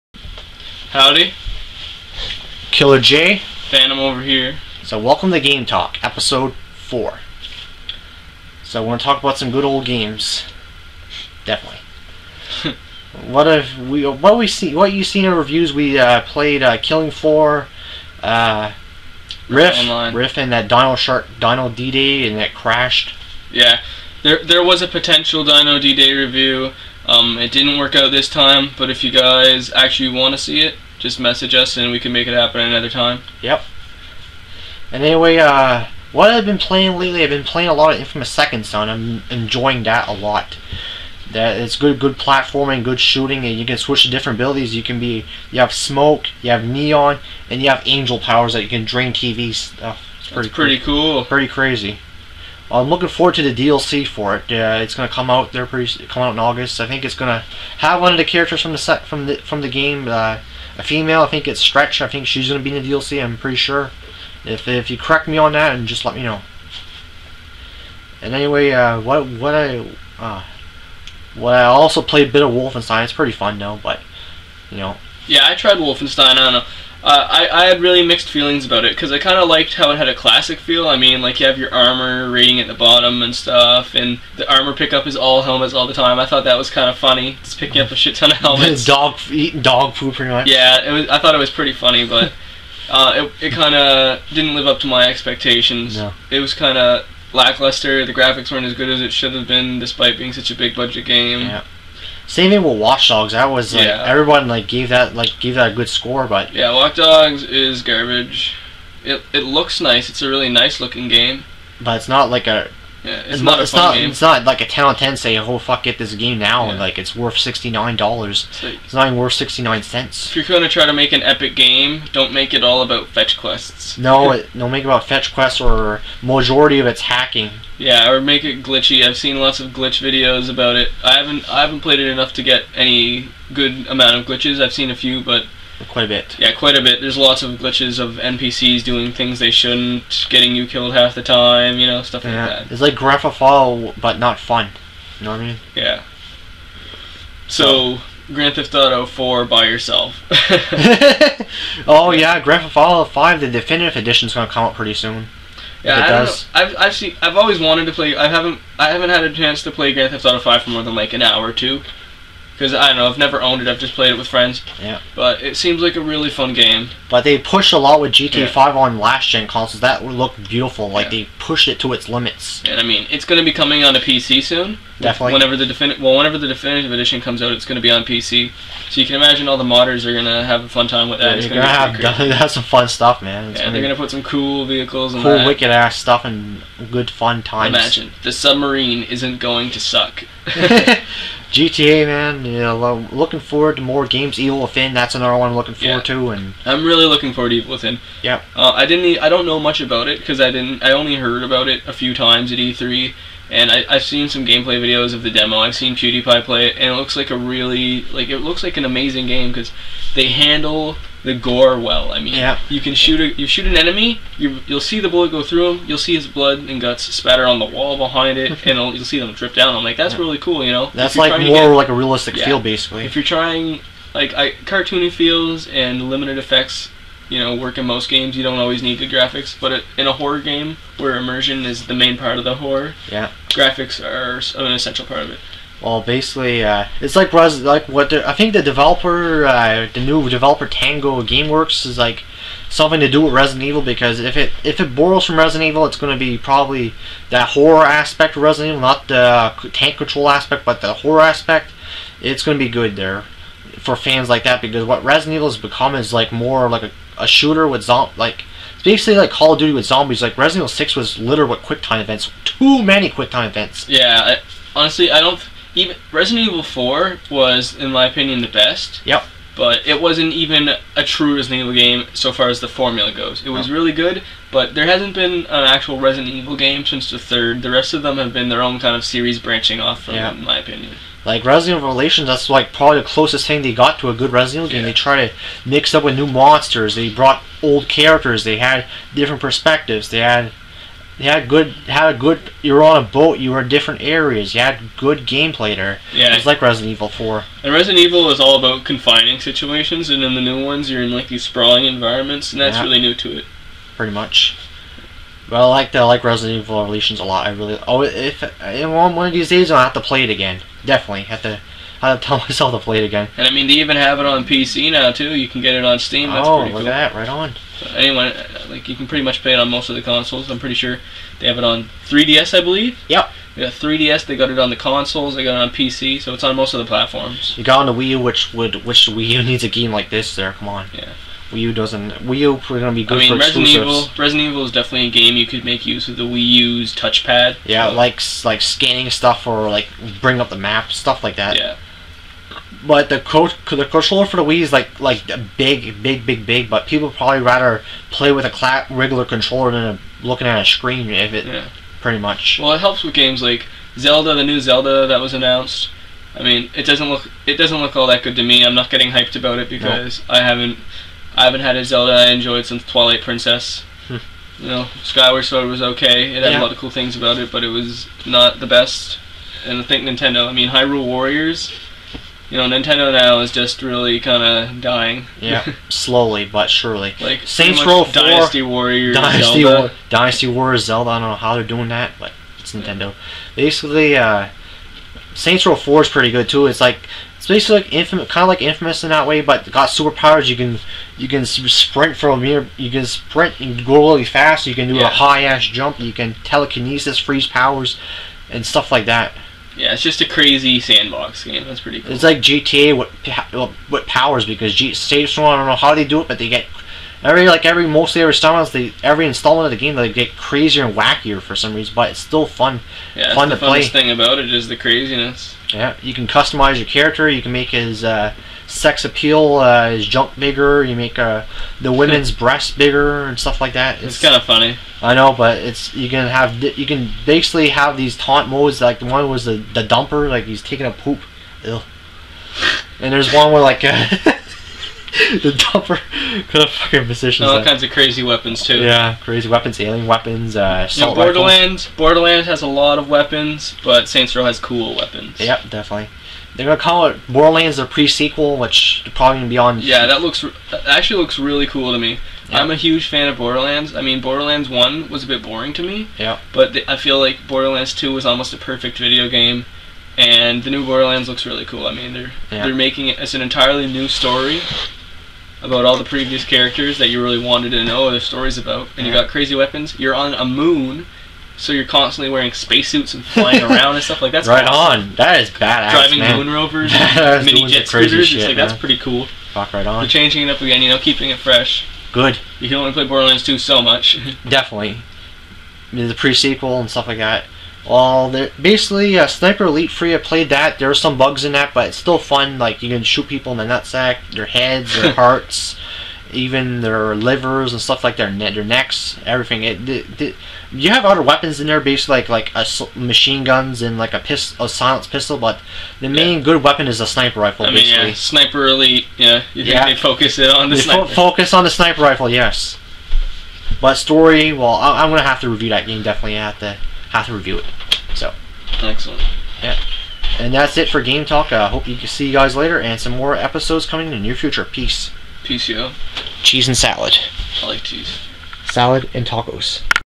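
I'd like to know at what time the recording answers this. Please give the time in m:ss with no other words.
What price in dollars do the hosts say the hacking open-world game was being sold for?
1:57.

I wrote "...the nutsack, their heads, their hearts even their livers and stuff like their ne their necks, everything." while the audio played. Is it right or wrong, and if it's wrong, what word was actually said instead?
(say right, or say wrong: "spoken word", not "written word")
right.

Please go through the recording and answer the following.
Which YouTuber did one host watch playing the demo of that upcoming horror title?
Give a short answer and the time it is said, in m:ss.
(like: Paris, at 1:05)
PewDiePie, at 3:25.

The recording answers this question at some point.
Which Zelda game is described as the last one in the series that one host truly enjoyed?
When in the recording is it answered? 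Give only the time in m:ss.
6:02.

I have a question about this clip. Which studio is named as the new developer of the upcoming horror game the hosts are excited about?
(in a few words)
Tango GameWorks.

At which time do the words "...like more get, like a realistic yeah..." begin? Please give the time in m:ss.
3:41.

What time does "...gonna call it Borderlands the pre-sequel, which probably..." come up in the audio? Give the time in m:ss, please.
7:26.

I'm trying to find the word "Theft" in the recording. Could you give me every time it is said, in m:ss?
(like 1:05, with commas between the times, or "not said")
2:23, 2:28, 2:32, 2:40.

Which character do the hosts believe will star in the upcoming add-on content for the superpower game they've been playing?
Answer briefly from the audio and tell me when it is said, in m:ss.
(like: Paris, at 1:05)
Stretch, at 1:01.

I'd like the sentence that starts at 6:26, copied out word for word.
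It's like it's basically like infamous, kind of like infamous in that way, but got superpowers.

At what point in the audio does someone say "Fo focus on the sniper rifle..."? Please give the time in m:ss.
8:31.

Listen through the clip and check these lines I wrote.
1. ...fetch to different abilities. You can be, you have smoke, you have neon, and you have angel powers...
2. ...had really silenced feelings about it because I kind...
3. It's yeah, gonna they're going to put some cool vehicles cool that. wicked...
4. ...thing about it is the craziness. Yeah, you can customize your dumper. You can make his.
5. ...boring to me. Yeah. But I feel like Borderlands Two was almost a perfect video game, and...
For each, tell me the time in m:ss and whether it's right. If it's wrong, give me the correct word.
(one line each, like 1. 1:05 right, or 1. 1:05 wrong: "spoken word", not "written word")
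1. 0:43 wrong: "switch", not "fetch"
2. 1:17 wrong: "mixed", not "silenced"
3. 3:03 right
4. 6:53 wrong: "character", not "dumper"
5. 7:35 right.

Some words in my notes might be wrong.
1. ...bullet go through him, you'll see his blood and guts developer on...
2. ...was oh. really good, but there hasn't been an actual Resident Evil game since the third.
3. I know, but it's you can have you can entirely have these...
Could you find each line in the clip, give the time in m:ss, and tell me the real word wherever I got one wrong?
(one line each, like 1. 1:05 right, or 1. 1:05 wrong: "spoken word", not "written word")
1. 3:35 wrong: "spatter", not "developer"
2. 4:33 right
3. 7:05 wrong: "basically", not "entirely".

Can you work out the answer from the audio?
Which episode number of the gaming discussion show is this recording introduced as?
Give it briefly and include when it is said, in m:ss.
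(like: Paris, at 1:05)
4, at 0:06.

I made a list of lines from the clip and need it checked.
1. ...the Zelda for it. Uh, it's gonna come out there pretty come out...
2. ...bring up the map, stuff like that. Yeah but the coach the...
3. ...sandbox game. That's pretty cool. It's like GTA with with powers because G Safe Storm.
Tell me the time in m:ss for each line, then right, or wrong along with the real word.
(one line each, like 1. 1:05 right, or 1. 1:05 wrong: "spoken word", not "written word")
1. 0:53 wrong: "DLC", not "Zelda"
2. 5:40 right
3. 6:40 right.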